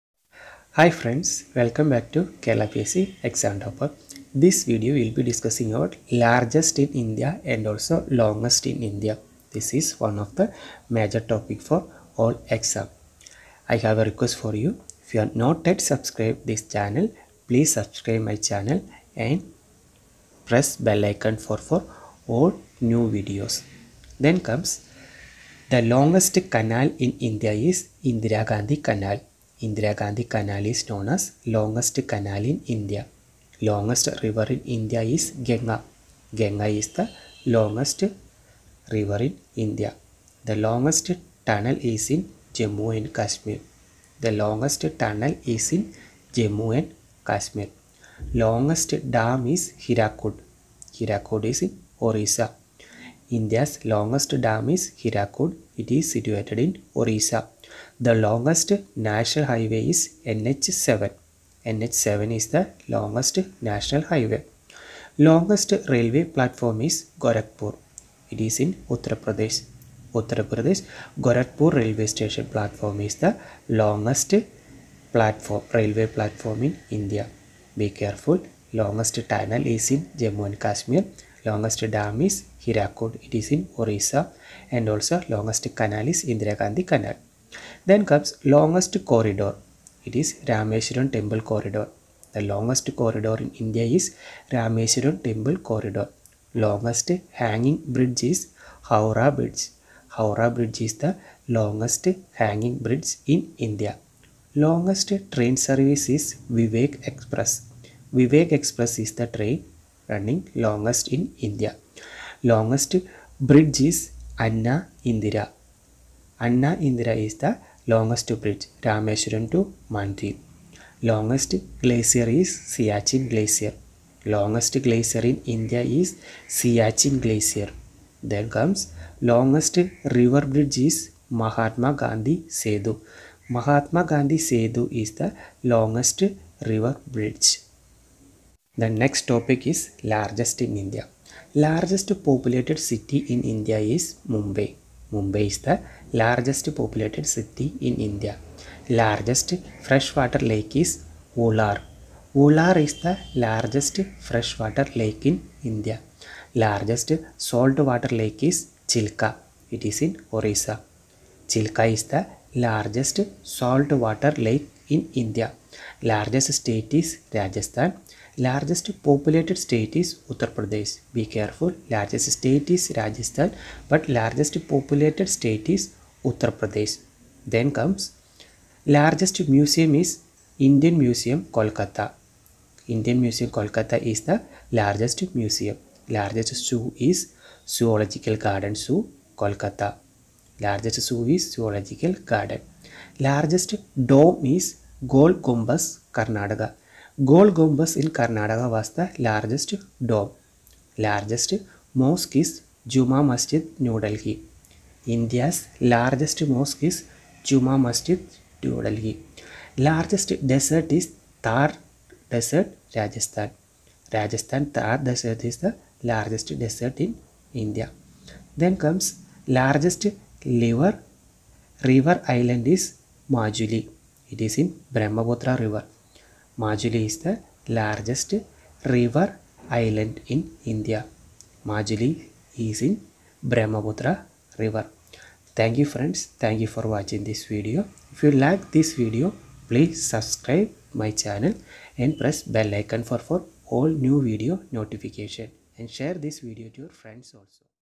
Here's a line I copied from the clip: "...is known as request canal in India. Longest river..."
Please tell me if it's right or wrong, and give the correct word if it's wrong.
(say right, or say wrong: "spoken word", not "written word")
wrong: "longest", not "request".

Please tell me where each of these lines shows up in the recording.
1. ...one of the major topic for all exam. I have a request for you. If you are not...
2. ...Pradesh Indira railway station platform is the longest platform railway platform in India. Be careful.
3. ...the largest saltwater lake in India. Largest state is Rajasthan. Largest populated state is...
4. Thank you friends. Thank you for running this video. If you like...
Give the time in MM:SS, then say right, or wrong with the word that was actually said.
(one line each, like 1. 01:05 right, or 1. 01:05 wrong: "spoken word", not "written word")
1. 00:09 right
2. 01:10 wrong: "Gorakhpur", not "Indira"
3. 02:42 right
4. 03:55 wrong: "watching", not "running".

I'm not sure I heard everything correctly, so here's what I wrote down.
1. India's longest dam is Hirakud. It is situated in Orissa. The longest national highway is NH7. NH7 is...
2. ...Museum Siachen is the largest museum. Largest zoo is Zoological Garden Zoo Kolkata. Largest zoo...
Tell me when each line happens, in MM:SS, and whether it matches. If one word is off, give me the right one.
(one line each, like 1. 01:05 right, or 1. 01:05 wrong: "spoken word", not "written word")
1. 00:53 right
2. 03:03 wrong: "Kolkata", not "Siachen".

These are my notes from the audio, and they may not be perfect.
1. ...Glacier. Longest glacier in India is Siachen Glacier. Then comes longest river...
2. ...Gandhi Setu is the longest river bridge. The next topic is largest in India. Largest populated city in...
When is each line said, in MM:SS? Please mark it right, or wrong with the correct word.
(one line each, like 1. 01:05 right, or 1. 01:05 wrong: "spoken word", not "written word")
1. 02:03 right
2. 02:14 right.